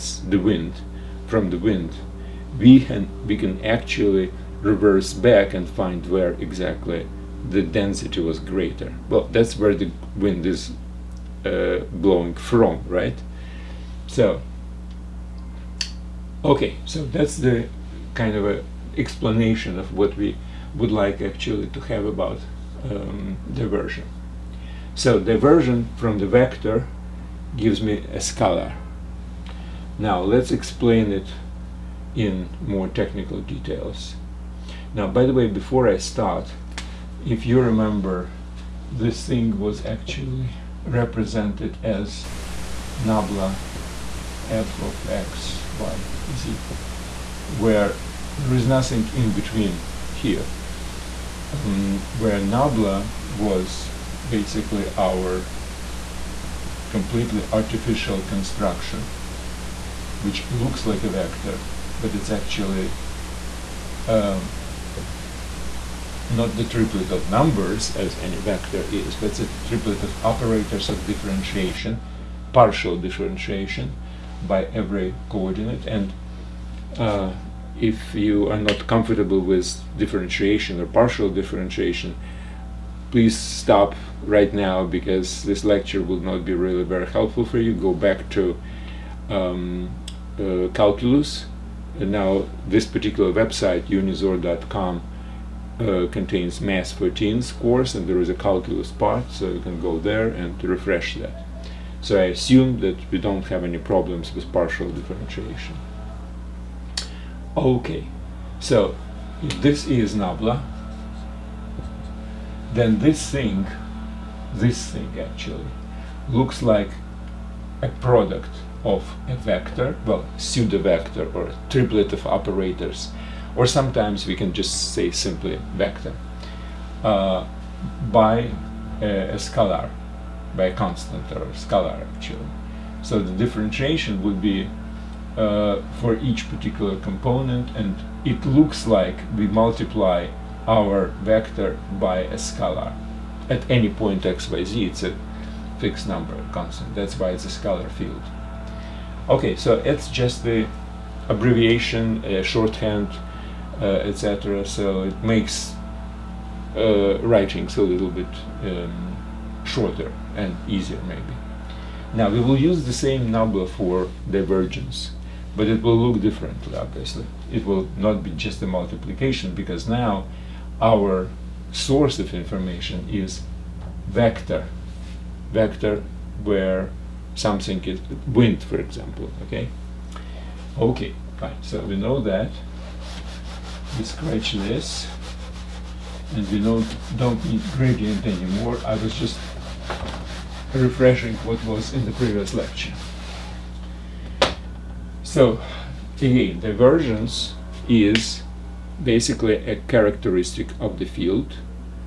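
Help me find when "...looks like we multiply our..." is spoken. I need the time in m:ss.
2:18.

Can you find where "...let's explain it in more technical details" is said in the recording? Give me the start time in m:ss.
0:30.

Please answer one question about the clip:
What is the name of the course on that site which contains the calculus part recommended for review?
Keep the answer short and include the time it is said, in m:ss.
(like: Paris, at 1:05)
Math 4 Teens, at 1:36.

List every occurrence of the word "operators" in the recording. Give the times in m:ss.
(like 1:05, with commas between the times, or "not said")
1:10, 2:02.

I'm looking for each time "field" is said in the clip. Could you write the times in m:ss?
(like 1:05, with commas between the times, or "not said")
2:27, 3:21.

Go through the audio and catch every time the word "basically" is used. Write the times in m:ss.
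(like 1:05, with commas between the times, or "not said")
0:54, 3:19.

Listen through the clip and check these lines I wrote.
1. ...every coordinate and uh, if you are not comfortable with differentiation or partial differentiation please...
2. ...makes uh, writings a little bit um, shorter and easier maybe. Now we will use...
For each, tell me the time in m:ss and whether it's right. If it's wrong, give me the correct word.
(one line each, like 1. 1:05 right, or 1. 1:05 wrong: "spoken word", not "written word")
1. 1:14 right
2. 2:35 right.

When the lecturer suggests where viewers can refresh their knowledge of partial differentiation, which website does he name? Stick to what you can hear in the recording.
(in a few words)
unizor.com.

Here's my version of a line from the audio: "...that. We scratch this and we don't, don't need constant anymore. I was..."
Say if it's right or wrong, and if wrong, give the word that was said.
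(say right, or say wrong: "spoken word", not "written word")
wrong: "gradient", not "constant".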